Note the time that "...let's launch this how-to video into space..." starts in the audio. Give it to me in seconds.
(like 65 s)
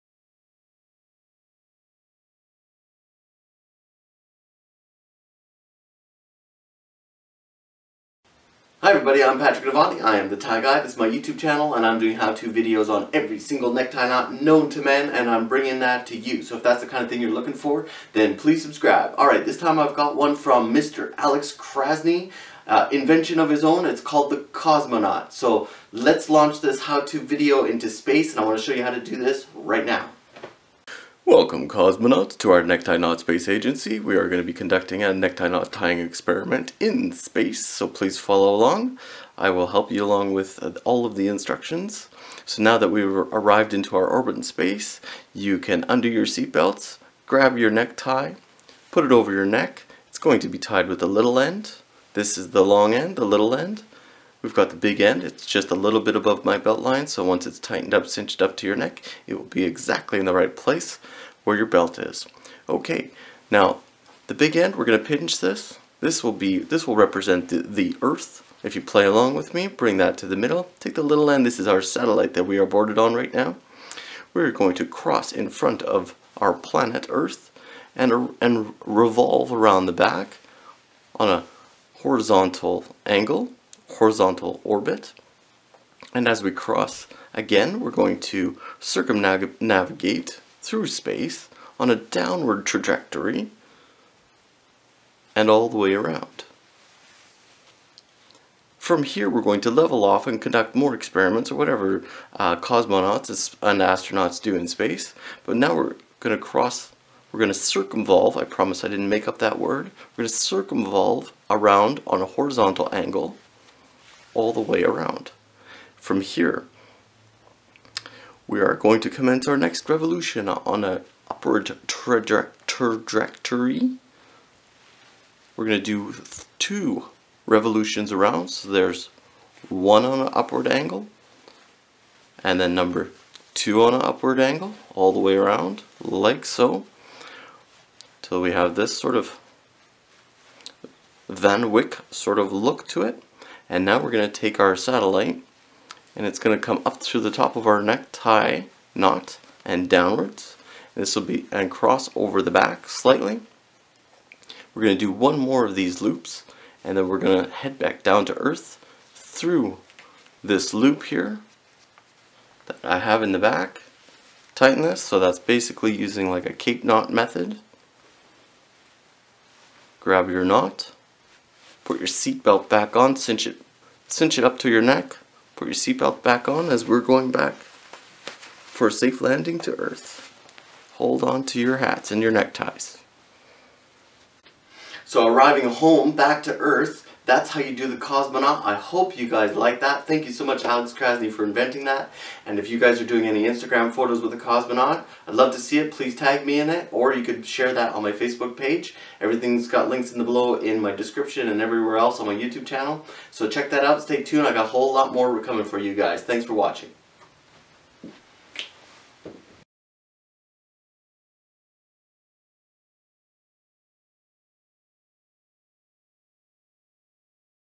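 25 s.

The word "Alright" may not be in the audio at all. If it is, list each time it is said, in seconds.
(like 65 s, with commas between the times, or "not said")
19 s.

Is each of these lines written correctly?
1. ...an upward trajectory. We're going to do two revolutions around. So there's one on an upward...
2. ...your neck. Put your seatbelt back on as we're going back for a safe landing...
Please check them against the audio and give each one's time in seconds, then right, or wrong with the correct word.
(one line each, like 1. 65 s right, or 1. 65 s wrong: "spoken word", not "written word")
1. 120 s right
2. 174 s right.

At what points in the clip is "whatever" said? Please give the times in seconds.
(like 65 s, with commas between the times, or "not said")
101 s.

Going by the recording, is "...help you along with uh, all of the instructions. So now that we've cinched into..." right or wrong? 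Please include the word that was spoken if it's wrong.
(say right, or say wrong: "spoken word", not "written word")
wrong: "arrived", not "cinched".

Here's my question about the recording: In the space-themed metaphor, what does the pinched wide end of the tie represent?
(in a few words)
The earth.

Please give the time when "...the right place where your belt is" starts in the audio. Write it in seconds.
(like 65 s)
60 s.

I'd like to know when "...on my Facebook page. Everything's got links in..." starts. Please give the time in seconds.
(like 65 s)
197 s.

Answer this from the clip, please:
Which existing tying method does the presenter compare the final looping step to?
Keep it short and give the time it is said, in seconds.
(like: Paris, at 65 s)
Cape knot method, at 166 s.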